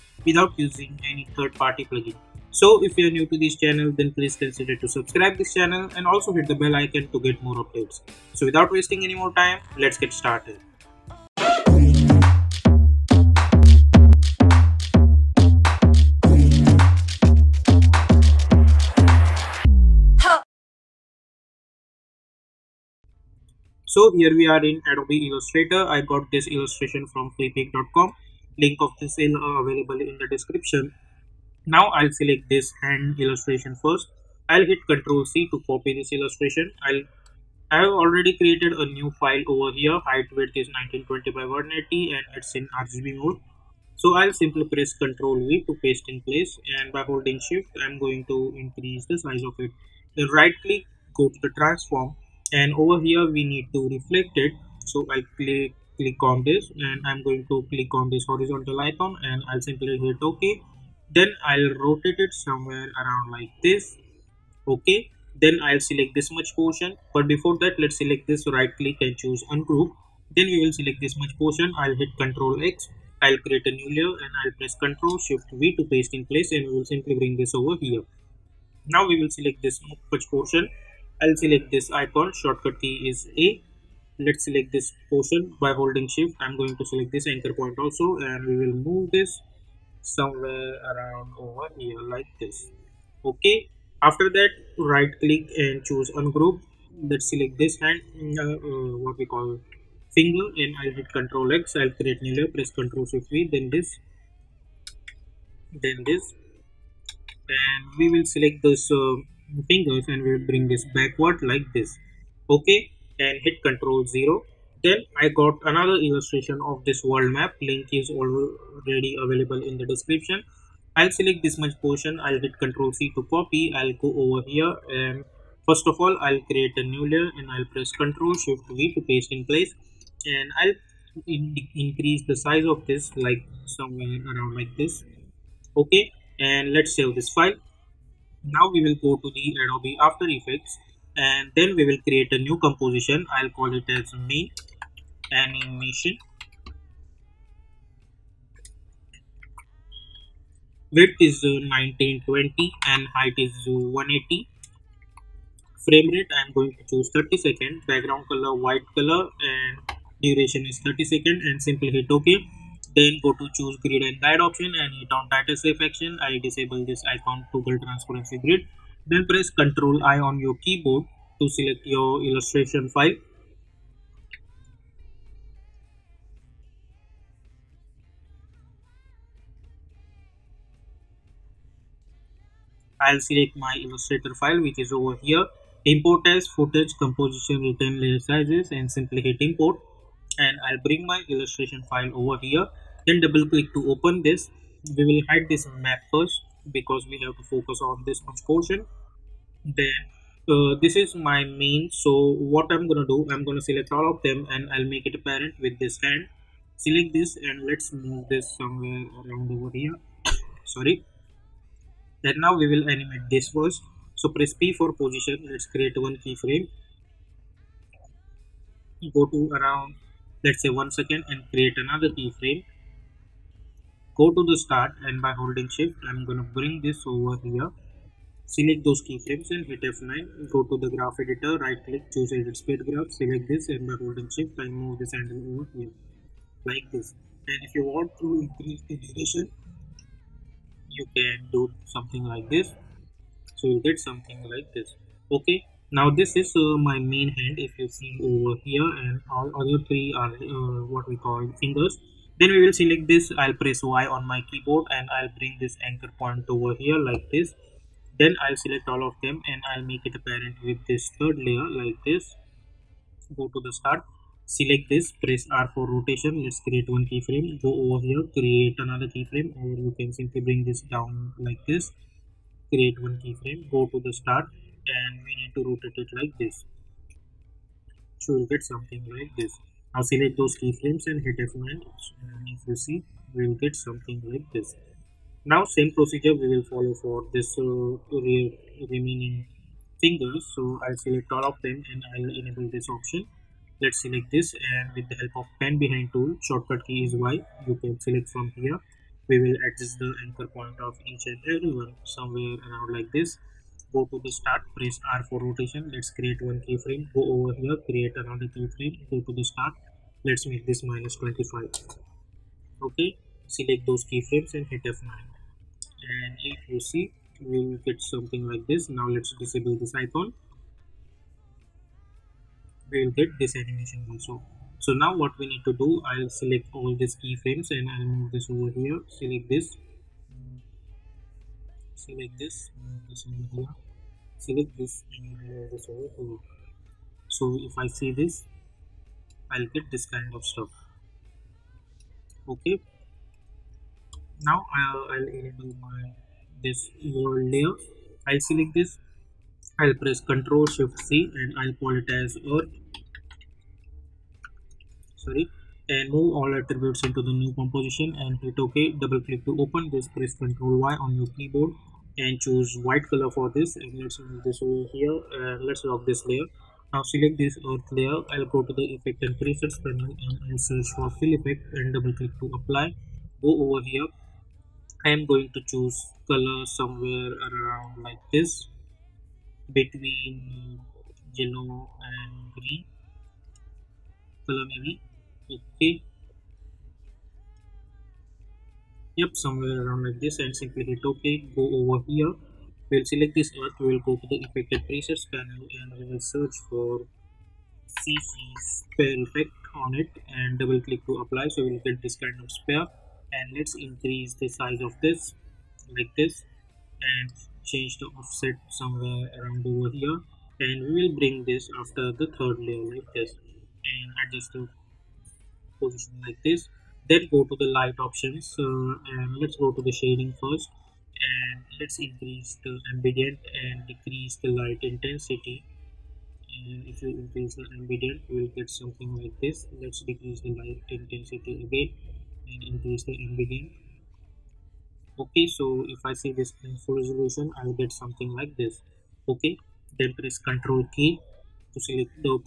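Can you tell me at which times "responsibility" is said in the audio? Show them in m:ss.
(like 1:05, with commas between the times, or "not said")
not said.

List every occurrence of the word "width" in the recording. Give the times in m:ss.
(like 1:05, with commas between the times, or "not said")
0:40, 2:30.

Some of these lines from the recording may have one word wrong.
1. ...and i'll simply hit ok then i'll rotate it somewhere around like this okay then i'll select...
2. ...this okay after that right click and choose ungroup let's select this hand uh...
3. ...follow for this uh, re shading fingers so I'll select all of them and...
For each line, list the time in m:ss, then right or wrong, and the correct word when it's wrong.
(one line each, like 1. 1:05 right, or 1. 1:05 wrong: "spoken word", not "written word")
1. 0:59 right
2. 1:32 right
3. 4:46 wrong: "remaining", not "shading".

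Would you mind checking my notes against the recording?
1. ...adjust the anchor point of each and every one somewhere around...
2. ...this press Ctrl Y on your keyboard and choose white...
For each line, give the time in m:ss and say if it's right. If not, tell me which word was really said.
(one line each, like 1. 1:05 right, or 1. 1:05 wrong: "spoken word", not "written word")
1. 4:59 right
2. 5:59 right.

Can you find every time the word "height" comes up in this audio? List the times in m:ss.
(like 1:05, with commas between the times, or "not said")
0:39, 2:33.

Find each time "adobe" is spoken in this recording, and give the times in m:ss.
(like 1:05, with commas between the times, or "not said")
0:24, 2:19.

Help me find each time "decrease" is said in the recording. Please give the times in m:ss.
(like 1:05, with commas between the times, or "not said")
7:03, 7:10.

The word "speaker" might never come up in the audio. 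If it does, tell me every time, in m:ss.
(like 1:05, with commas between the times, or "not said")
not said.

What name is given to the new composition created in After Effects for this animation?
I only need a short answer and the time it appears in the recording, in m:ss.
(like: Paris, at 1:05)
me animation, at 2:24.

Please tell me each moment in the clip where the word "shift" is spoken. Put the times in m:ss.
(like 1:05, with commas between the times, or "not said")
0:47, 1:15, 1:26, 1:43, 2:08, 3:45, 3:54, 5:50.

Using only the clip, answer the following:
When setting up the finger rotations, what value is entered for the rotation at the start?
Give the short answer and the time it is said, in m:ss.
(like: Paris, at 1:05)
-25, at 5:10.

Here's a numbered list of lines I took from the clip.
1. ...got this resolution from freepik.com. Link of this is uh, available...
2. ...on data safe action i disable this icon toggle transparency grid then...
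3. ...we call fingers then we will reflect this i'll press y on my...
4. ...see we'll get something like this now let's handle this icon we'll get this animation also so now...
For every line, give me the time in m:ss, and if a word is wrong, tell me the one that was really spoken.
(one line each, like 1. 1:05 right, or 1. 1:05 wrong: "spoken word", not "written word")
1. 0:26 wrong: "illustration", not "resolution"
2. 2:45 right
3. 4:11 wrong: "select", not "reflect"
4. 5:16 wrong: "disable", not "handle".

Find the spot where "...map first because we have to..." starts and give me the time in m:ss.
3:15.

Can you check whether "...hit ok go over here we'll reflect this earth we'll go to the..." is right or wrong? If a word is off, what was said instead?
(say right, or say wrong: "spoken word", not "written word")
wrong: "select", not "reflect".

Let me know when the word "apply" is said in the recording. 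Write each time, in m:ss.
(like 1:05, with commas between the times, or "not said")
6:12, 6:41.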